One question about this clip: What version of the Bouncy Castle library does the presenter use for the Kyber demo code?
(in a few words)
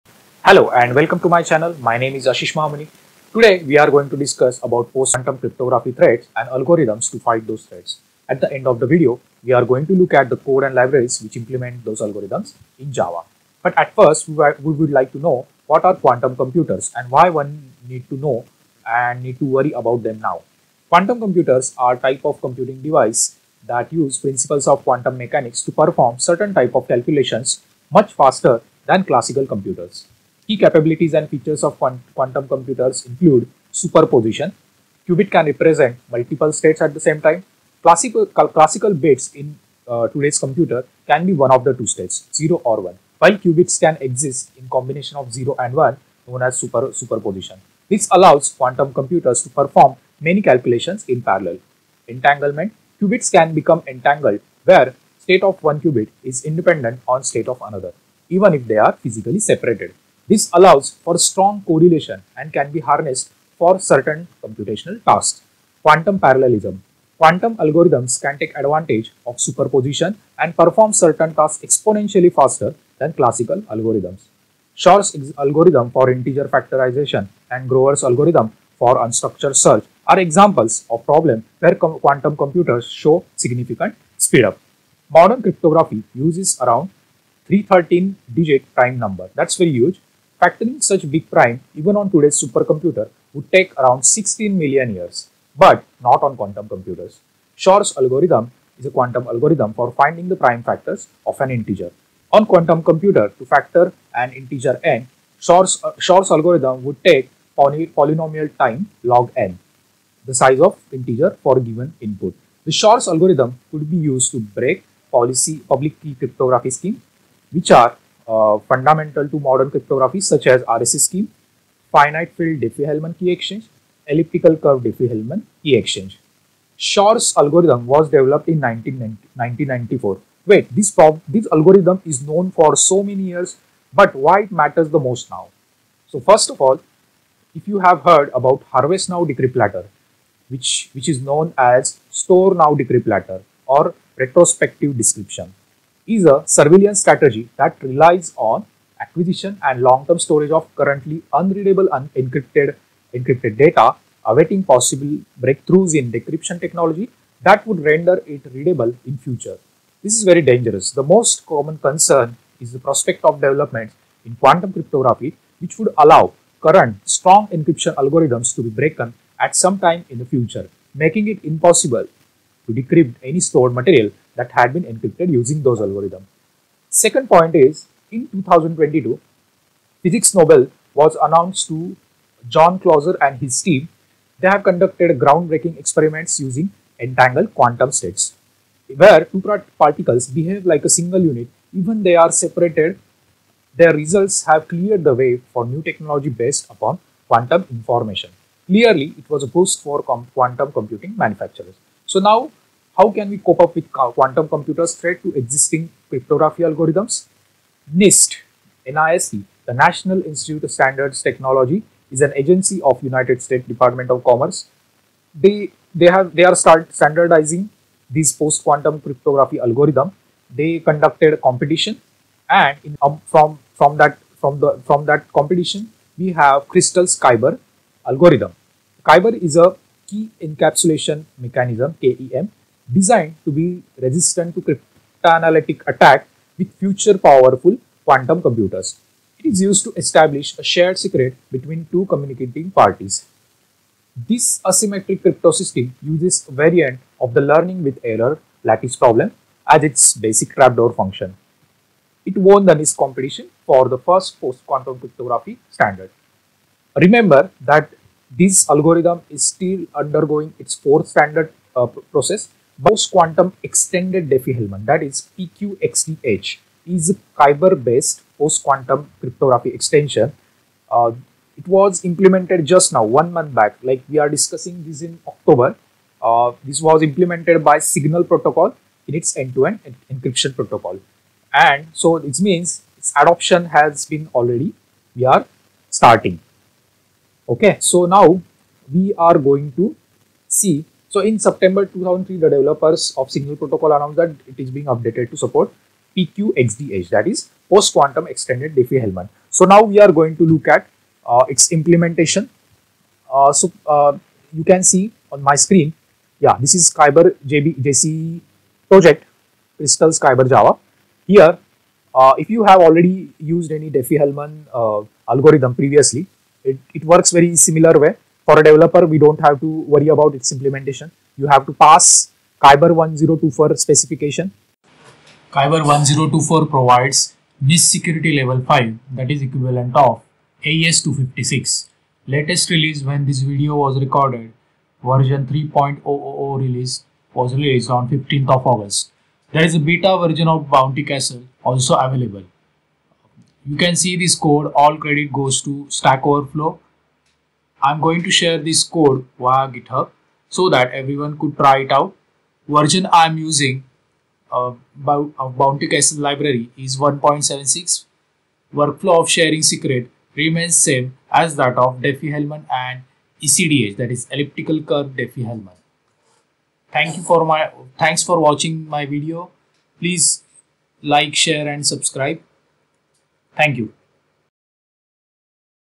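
1.76.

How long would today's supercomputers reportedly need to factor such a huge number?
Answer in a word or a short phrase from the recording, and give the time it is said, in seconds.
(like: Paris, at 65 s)
16 million years, at 94 s.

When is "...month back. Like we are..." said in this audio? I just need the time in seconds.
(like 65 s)
273 s.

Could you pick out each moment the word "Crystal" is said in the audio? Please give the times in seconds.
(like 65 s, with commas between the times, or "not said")
226 s, 309 s.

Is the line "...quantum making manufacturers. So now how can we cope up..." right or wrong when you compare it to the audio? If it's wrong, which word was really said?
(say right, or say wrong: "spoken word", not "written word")
wrong: "computing", not "making".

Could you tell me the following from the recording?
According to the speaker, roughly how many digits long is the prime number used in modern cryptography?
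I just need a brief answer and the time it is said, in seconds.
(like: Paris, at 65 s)
313, at 87 s.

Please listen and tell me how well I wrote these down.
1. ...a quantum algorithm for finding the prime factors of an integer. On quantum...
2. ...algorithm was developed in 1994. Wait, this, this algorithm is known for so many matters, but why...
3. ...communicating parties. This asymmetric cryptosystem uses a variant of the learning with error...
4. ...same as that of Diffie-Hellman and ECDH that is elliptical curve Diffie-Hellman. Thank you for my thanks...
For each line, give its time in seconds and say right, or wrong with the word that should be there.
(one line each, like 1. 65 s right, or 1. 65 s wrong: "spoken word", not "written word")
1. 98 s right
2. 127 s wrong: "years", not "matters"
3. 242 s right
4. 360 s right.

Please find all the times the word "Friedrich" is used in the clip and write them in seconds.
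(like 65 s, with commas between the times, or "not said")
not said.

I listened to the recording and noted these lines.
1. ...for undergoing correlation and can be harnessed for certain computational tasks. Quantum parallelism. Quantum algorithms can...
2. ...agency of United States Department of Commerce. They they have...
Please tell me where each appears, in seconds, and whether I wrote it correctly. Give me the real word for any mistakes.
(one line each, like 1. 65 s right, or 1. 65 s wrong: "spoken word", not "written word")
1. 61 s wrong: "strong", not "undergoing"
2. 212 s right.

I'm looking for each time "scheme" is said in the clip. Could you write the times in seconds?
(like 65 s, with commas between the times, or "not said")
116 s, 120 s.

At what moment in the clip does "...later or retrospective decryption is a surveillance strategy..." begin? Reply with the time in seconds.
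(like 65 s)
143 s.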